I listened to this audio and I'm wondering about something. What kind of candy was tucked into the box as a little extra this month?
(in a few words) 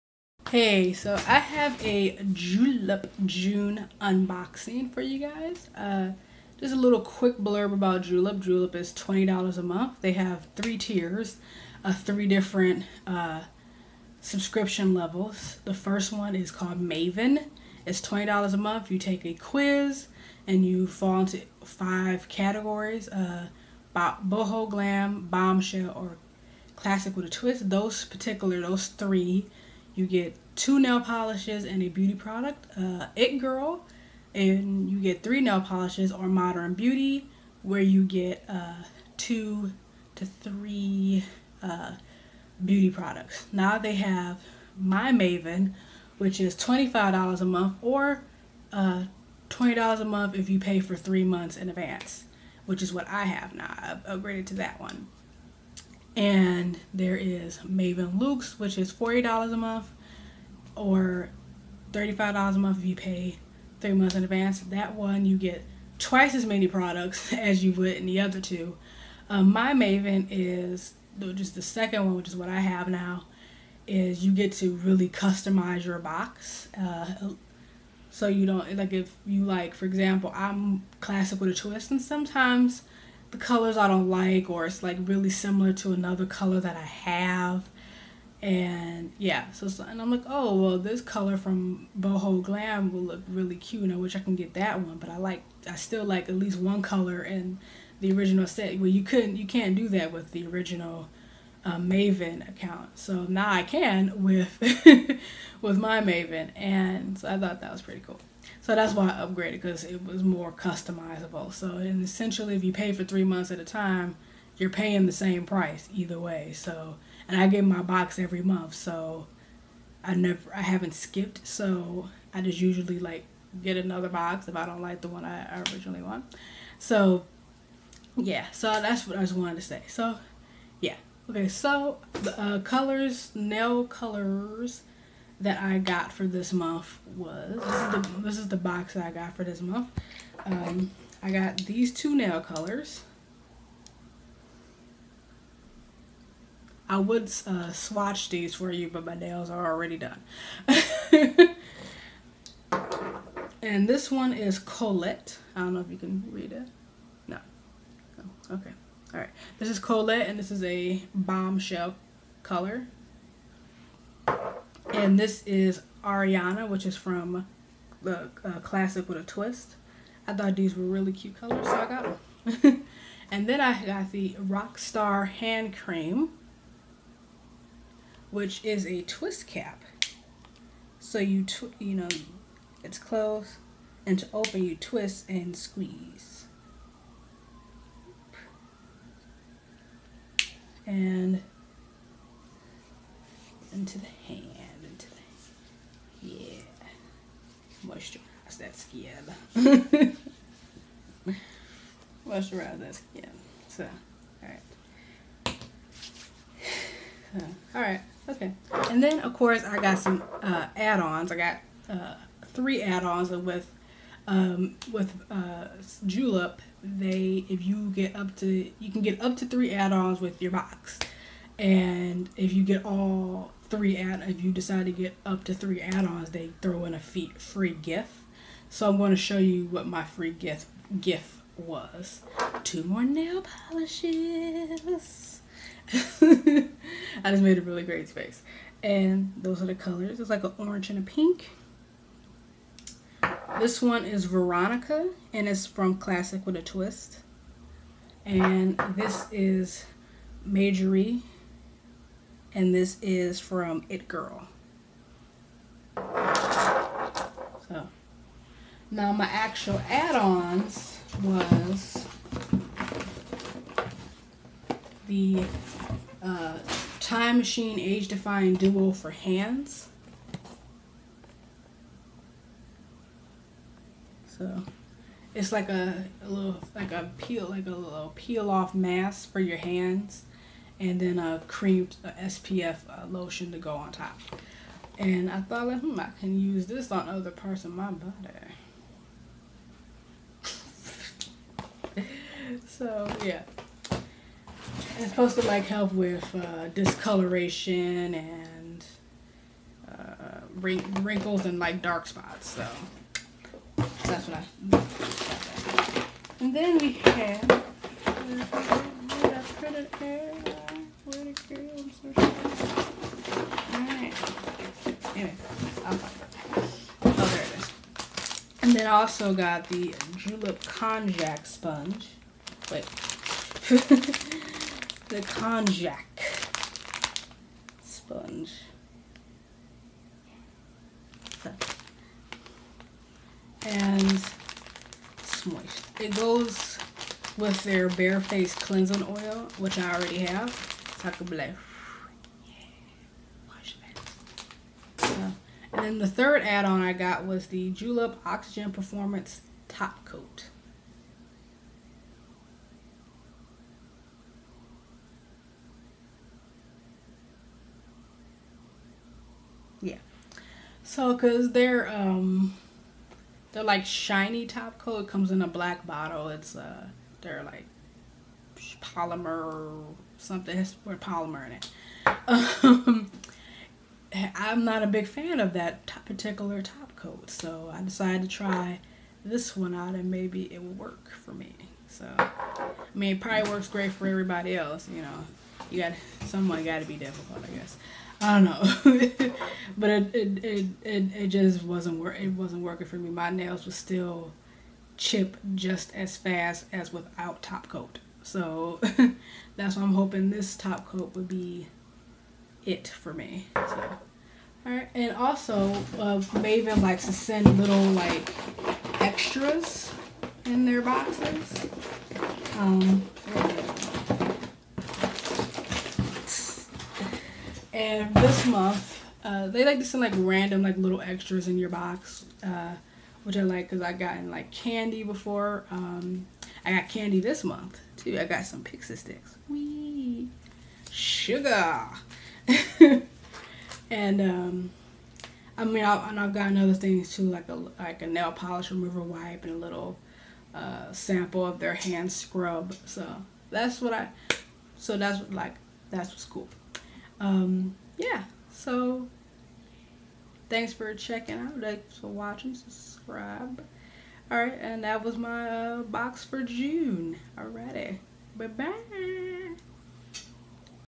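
Pixy Stix.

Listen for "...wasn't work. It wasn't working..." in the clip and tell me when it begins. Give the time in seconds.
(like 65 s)
391 s.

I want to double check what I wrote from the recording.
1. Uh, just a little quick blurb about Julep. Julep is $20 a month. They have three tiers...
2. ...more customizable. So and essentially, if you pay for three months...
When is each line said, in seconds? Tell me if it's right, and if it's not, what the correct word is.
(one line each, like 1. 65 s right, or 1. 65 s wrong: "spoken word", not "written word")
1. 5 s right
2. 110 s right.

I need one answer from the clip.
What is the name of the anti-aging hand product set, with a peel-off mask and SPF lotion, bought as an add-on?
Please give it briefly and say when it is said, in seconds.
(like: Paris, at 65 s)
Time Machine Age Defying Duo, at 266 s.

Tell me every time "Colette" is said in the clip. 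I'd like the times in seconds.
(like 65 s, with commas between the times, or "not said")
154 s, 159 s.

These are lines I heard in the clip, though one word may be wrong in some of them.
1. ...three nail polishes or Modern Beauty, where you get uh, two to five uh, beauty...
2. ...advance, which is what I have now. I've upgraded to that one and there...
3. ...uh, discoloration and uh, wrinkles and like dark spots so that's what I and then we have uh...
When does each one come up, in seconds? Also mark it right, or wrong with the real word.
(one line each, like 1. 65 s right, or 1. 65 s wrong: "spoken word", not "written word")
1. 35 s wrong: "three", not "five"
2. 51 s right
3. 296 s right.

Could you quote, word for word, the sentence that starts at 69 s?
Um, my Maven is just the second one, which is what I have now.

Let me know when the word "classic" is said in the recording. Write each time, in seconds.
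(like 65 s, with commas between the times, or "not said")
26 s, 80 s, 168 s, 245 s.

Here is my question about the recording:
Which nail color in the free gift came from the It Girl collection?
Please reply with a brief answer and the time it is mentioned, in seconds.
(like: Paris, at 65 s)
Majorie, at 250 s.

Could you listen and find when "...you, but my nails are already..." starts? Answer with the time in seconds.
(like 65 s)
148 s.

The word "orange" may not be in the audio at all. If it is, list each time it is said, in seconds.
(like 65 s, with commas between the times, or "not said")
240 s.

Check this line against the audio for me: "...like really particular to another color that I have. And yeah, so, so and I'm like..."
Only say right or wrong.
wrong.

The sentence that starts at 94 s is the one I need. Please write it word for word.
But I like, I still like at least one color in the original set.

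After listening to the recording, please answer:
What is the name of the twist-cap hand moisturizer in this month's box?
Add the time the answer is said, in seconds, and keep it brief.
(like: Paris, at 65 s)
Rockstar Hand Cream, at 174 s.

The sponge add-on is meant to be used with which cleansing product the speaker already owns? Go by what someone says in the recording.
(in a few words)
Bare Face Cleansing Oil.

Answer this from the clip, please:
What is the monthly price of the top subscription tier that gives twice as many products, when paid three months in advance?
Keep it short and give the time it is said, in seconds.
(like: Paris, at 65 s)
$35, at 61 s.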